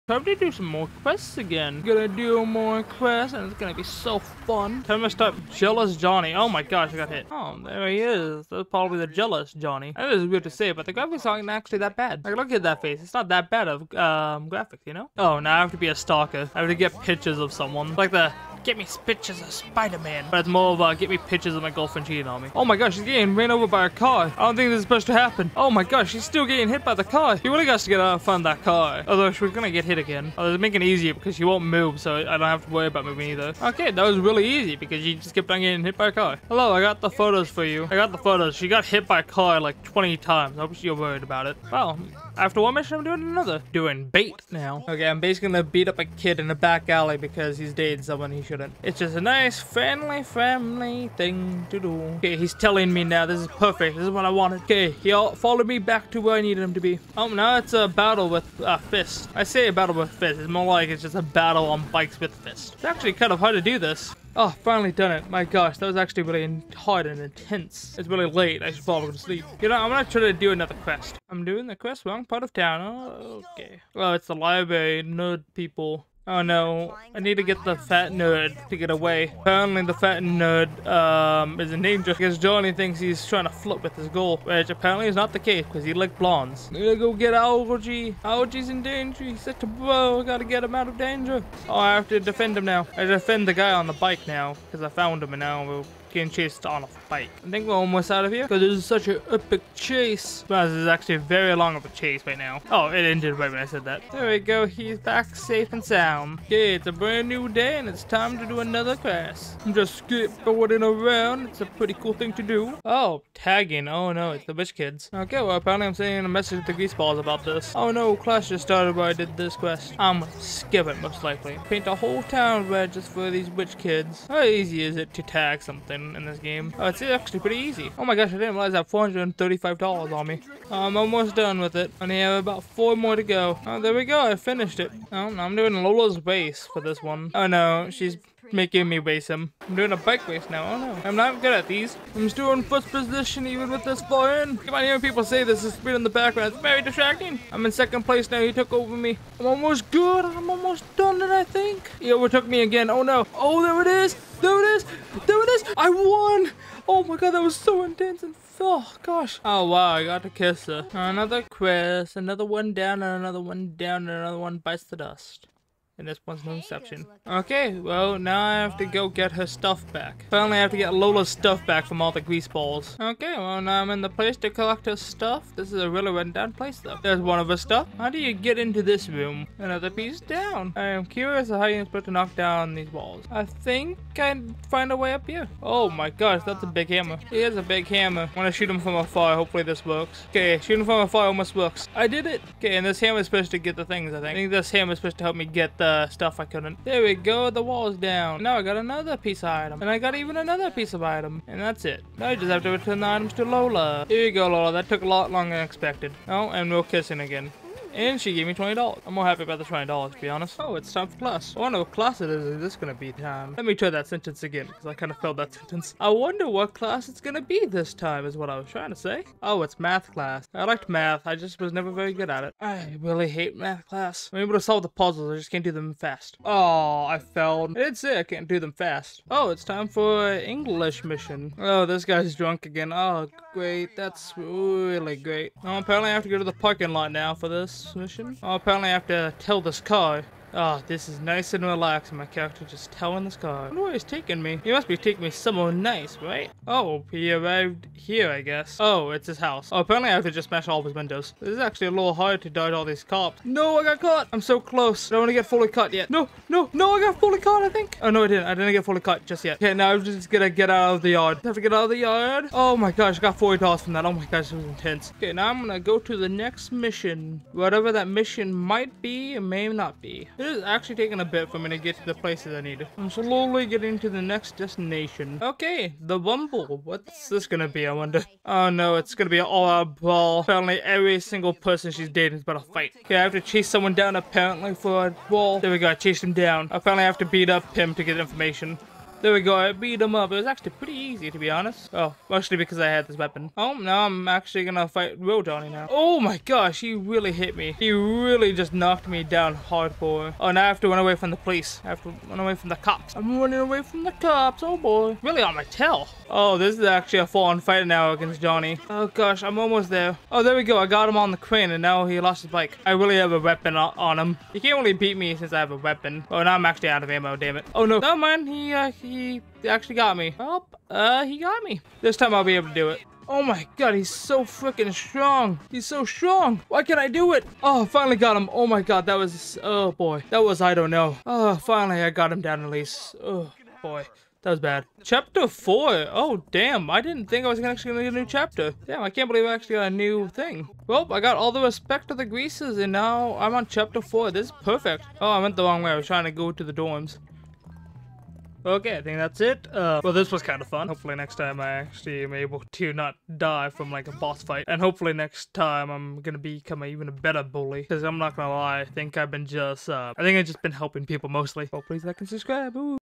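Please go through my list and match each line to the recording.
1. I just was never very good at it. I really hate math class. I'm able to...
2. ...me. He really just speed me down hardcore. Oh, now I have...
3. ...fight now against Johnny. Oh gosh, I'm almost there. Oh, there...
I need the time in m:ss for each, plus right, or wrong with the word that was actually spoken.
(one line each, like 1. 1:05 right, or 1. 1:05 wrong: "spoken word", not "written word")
1. 3:41 right
2. 4:57 wrong: "knocked", not "speed"
3. 5:07 right.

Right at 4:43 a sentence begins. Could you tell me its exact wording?
Okay, I have to chase someone down apparently for a brawl.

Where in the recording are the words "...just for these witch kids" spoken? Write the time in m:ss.
2:02.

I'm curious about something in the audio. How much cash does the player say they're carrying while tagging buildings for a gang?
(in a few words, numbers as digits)
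$435.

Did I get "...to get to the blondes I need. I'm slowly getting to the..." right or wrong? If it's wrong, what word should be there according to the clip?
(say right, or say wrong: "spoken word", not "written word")
wrong: "places", not "blondes".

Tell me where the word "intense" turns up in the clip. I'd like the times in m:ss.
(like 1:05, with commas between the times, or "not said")
1:07, 2:37, 4:24.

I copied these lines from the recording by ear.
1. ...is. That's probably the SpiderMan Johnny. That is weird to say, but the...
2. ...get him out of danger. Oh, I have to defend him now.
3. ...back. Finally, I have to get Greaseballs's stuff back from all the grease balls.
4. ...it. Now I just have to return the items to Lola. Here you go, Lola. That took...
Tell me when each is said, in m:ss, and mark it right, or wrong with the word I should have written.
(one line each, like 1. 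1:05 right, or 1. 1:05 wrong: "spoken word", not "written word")
1. 0:07 wrong: "Jealous", not "SpiderMan"
2. 1:30 right
3. 2:49 wrong: "Lola", not "Greaseballs"
4. 3:21 right.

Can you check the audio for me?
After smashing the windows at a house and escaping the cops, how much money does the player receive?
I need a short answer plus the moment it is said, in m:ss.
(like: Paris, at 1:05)
$40, at 4:23.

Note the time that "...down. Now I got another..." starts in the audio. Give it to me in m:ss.
3:17.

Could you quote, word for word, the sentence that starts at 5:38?
Damn, I can't believe I actually got a new thing.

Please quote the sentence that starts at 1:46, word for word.
Okay, it's a brand new day and it's time to do another quest.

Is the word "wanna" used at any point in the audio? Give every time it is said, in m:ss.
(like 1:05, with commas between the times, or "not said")
not said.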